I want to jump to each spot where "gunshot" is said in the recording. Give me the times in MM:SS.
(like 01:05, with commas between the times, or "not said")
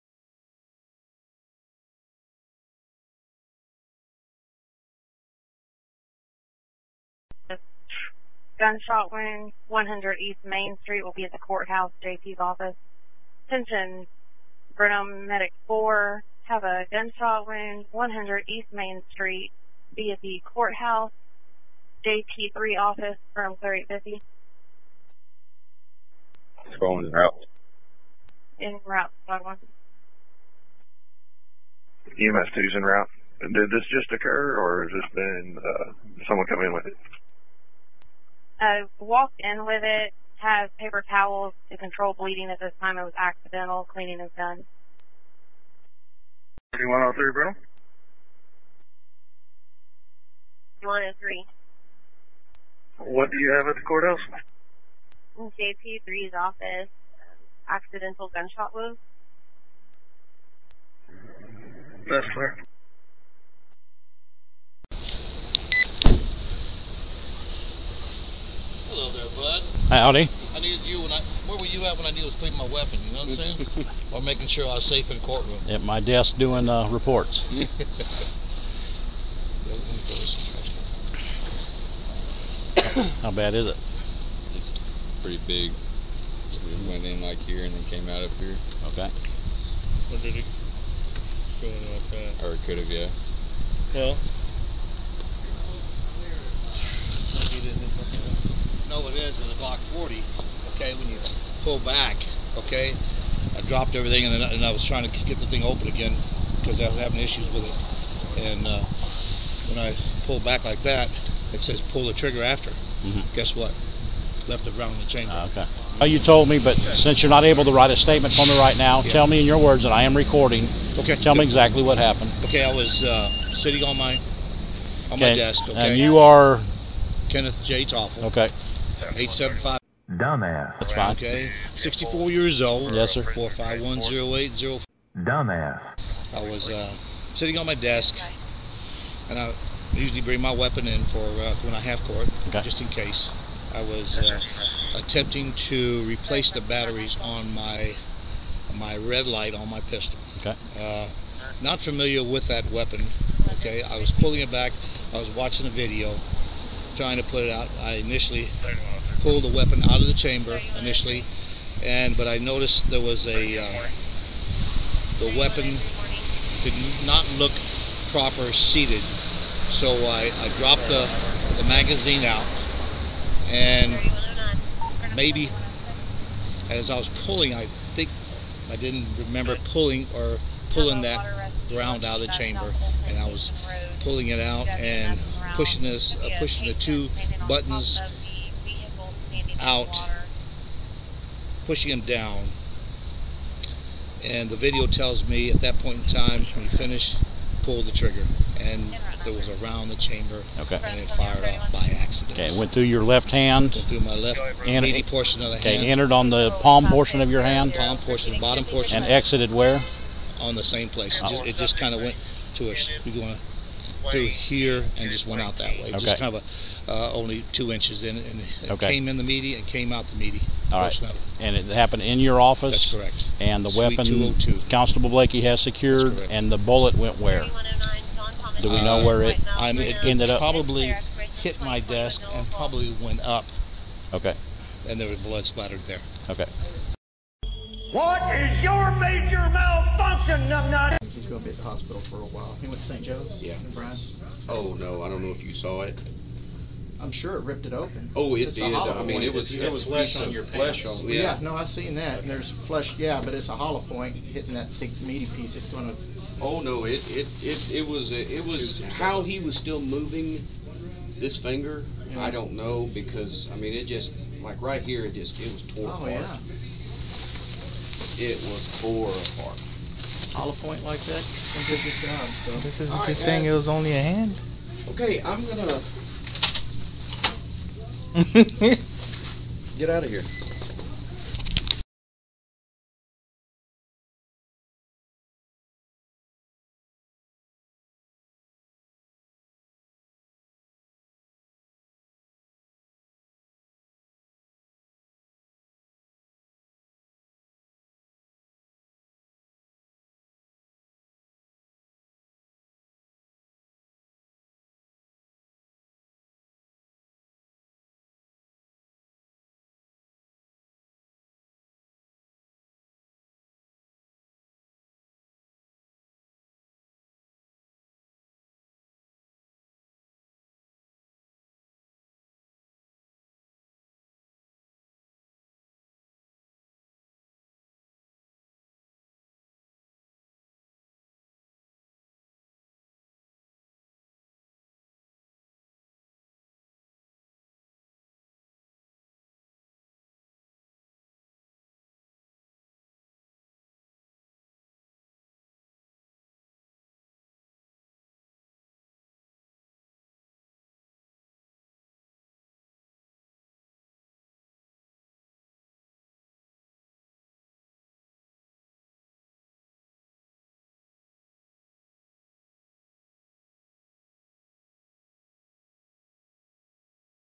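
00:08, 00:16, 00:58.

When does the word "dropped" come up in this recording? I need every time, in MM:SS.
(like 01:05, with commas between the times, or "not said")
01:43, 02:50.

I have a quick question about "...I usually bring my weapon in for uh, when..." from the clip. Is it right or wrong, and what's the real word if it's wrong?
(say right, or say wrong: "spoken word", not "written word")
right.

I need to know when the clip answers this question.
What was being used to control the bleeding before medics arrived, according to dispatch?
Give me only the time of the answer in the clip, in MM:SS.
00:40.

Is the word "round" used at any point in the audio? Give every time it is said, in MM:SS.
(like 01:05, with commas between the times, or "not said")
01:54, 03:01, 03:19.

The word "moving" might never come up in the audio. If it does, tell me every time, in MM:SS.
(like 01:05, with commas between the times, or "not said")
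04:19.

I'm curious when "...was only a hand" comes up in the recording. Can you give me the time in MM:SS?
04:33.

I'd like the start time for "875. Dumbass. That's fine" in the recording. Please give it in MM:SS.
02:09.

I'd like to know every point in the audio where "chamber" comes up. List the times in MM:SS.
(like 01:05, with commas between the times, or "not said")
01:55, 02:40, 03:02, 03:19.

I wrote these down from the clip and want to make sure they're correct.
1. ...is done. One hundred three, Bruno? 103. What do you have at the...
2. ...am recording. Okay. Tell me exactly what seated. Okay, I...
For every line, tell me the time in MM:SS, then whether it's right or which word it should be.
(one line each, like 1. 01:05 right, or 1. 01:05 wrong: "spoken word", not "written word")
1. 00:44 right
2. 02:00 wrong: "happened", not "seated".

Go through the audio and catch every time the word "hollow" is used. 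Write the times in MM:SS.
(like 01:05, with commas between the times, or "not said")
04:13, 04:30.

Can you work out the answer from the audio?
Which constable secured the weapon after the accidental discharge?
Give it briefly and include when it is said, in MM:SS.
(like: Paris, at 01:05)
Constable Blakey, at 03:44.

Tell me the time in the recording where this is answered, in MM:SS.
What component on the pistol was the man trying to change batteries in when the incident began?
02:28.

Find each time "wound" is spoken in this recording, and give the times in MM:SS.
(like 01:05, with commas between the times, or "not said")
00:09, 00:17, 00:58.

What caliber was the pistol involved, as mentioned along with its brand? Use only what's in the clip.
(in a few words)
40.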